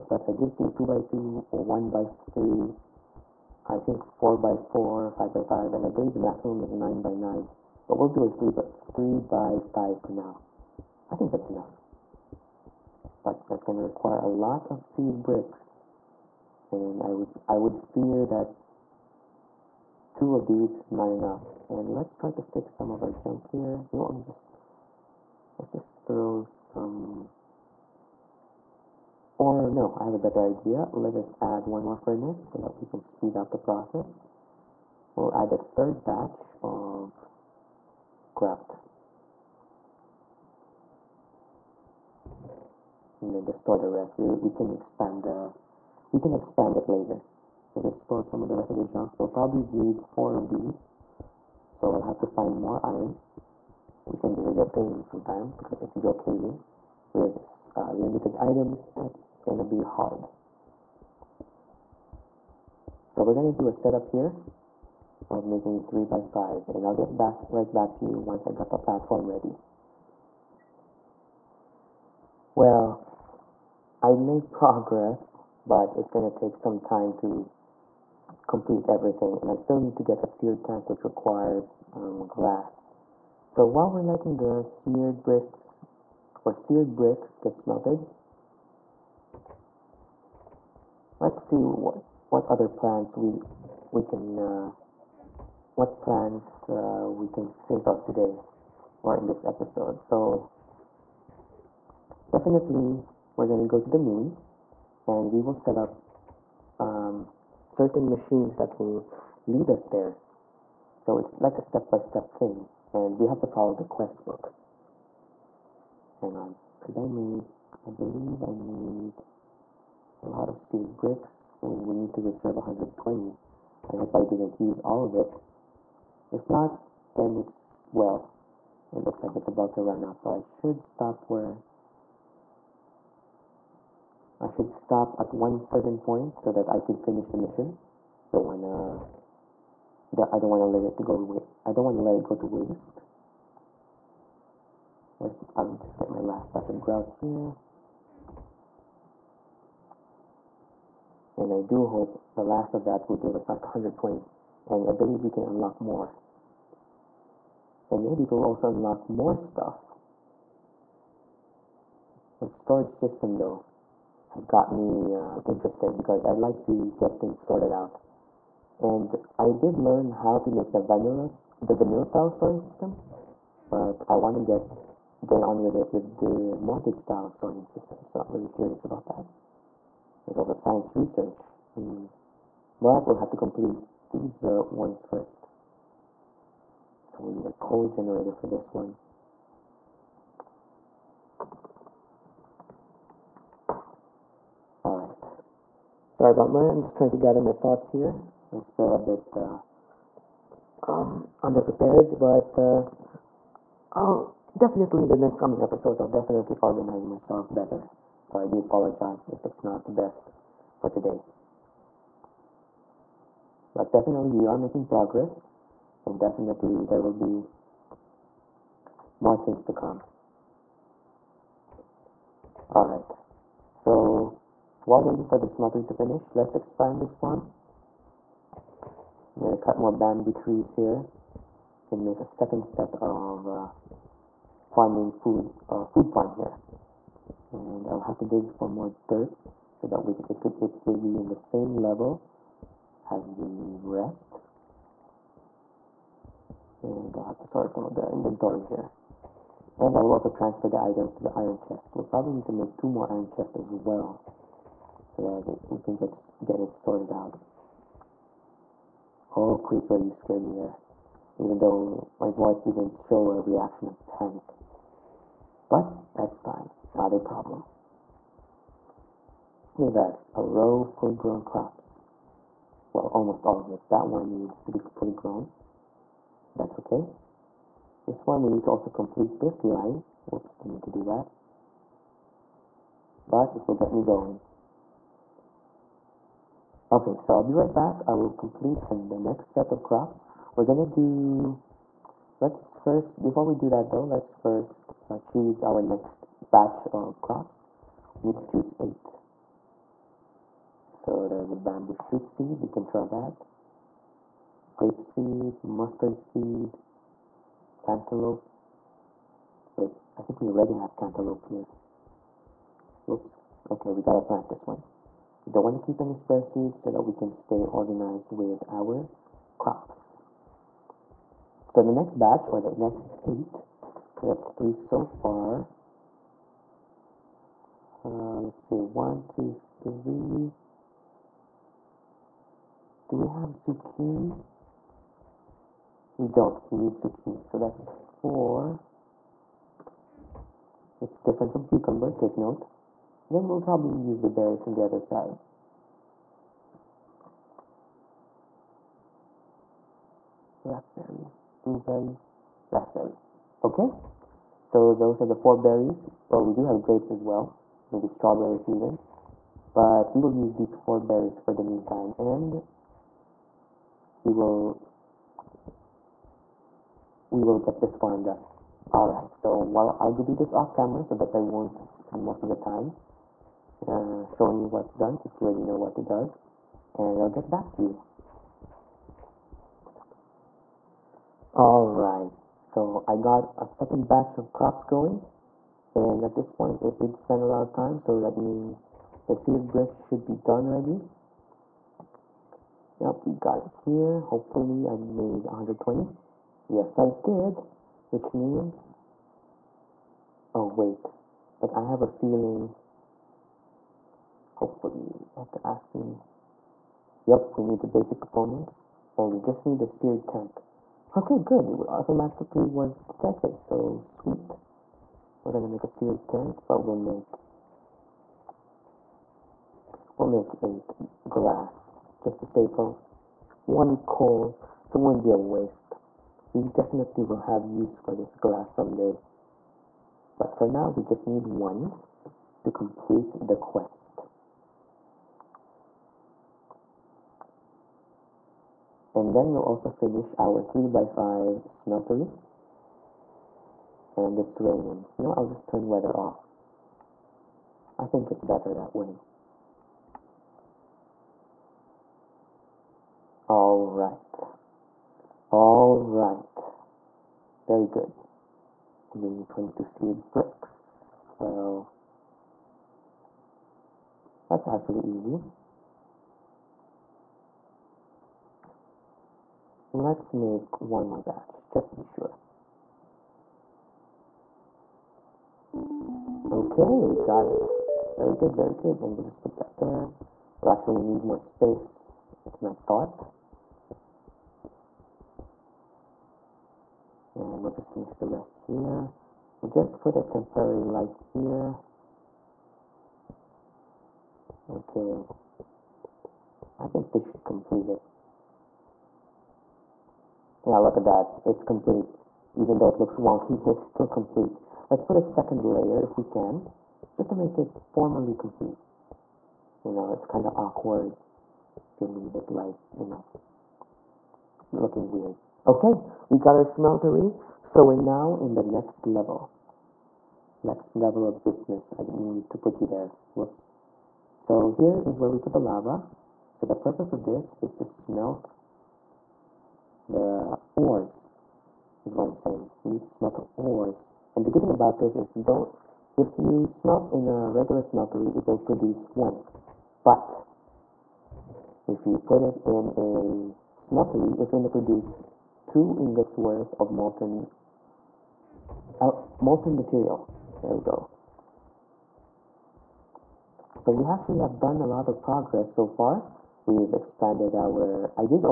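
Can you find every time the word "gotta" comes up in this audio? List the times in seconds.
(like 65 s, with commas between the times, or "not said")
313 s.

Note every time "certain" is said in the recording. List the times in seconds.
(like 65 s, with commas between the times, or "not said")
107 s, 135 s.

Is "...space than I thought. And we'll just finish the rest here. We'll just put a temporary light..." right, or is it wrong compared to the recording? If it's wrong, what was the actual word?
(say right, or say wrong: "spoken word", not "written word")
right.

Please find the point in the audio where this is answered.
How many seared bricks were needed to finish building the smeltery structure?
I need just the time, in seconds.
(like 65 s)
459 s.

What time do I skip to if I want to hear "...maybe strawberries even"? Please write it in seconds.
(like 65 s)
357 s.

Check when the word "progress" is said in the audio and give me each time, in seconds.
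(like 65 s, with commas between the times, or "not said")
74 s, 214 s, 555 s.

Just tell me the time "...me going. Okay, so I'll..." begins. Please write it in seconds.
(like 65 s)
283 s.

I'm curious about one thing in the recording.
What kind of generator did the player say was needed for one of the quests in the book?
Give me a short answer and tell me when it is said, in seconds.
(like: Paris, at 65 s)
code generator, at 187 s.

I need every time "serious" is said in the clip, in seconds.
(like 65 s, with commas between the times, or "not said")
not said.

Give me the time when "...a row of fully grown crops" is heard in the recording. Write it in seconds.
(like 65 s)
270 s.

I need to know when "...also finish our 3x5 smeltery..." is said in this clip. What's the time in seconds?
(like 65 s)
439 s.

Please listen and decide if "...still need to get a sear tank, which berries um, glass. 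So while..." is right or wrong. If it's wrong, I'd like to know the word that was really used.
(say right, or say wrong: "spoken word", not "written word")
wrong: "requires", not "berries".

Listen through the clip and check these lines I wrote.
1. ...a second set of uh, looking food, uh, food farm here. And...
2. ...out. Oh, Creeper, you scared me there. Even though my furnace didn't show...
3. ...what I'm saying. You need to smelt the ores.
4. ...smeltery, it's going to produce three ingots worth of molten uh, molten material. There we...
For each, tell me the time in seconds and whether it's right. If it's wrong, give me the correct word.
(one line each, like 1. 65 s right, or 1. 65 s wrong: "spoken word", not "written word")
1. 232 s wrong: "farming", not "looking"
2. 257 s wrong: "voice", not "furnace"
3. 532 s right
4. 543 s wrong: "two", not "three".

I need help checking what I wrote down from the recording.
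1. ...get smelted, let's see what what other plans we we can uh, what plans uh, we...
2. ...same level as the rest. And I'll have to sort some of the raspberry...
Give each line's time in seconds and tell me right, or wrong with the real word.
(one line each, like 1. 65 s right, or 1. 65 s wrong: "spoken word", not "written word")
1. 87 s right
2. 241 s wrong: "inventory", not "raspberry".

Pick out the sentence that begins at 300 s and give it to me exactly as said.
So there's a bamboo shoot seed, we can try that.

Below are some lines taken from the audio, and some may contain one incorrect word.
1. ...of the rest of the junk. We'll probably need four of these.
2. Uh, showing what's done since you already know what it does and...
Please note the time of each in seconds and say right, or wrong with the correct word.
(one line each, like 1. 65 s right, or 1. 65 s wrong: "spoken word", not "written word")
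1. 48 s right
2. 373 s right.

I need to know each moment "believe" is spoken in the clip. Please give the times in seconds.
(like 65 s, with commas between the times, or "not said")
5 s, 117 s, 154 s.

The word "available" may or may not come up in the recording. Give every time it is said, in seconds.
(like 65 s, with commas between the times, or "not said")
not said.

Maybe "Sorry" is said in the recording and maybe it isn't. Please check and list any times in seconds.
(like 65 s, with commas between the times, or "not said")
196 s.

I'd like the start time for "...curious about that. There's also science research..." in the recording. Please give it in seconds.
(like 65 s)
178 s.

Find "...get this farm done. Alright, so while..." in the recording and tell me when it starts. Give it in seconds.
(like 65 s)
367 s.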